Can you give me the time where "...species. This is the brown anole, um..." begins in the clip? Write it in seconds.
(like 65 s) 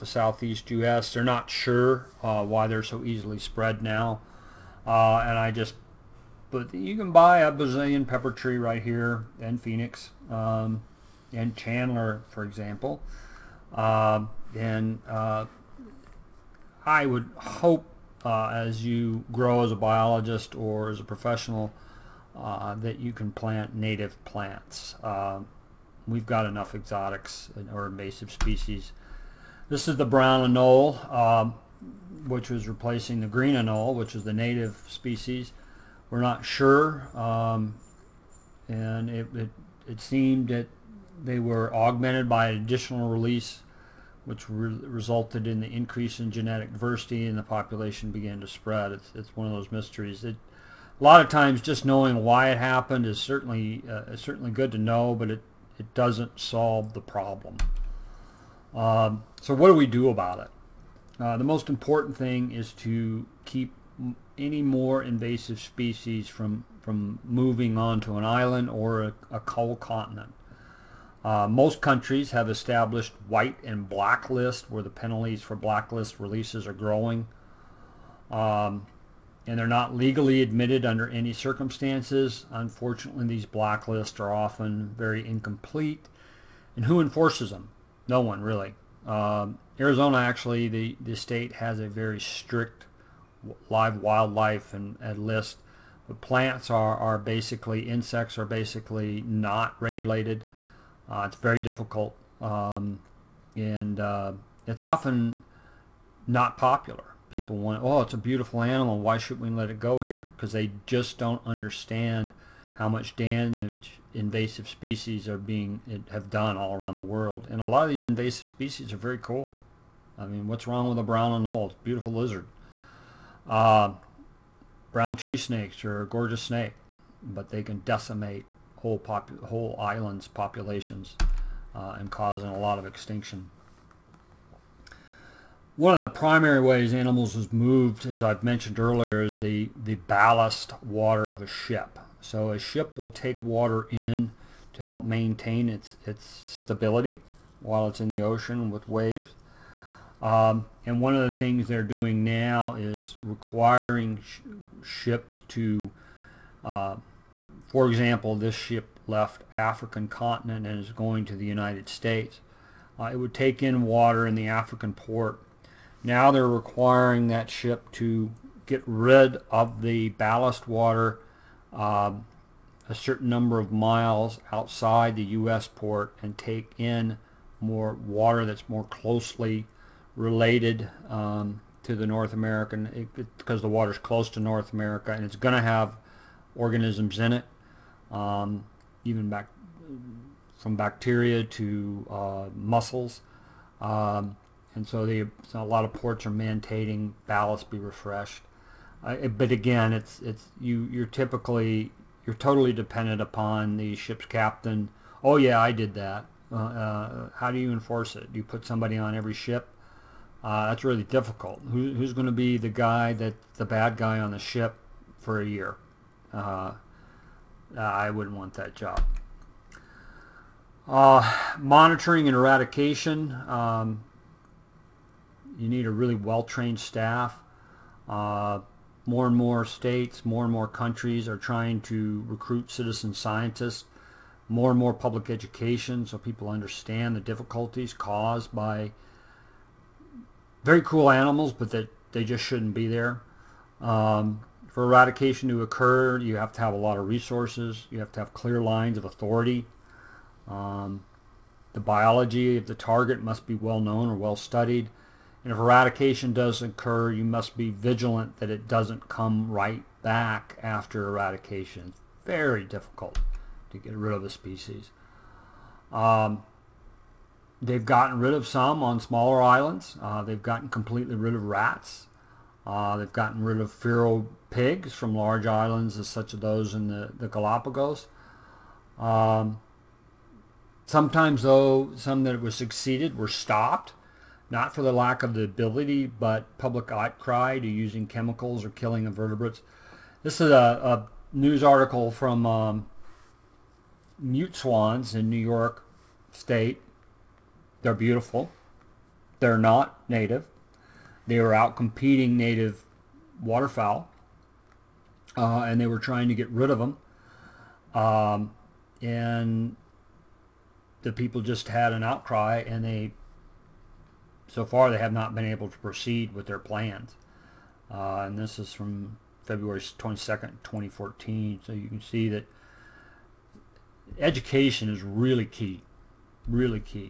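28 s.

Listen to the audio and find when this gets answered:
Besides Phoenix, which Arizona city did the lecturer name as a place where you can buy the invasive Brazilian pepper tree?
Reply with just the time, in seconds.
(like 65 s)
11 s.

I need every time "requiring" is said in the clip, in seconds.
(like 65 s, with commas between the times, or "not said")
153 s, 166 s.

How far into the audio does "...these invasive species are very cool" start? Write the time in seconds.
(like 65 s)
117 s.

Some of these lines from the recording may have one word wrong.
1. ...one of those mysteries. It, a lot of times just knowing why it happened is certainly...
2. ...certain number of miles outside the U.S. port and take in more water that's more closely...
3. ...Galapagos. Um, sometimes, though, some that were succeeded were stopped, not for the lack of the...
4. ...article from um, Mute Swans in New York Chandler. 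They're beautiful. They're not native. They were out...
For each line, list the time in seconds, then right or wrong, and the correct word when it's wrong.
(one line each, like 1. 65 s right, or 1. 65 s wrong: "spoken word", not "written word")
1. 49 s right
2. 172 s right
3. 277 s right
4. 291 s wrong: "State", not "Chandler".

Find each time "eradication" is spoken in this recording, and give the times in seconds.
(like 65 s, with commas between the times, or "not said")
222 s, 244 s, 255 s, 261 s.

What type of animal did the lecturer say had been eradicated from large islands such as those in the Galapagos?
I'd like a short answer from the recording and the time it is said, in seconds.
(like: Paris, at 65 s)
feral pigs, at 273 s.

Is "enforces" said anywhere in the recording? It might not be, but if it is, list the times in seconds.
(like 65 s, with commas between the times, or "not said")
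87 s, 207 s.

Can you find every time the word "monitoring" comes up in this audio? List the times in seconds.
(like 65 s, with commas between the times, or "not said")
221 s.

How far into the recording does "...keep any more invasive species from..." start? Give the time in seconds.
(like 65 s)
63 s.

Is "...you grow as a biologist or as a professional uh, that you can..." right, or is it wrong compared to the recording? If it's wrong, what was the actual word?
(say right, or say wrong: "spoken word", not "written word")
right.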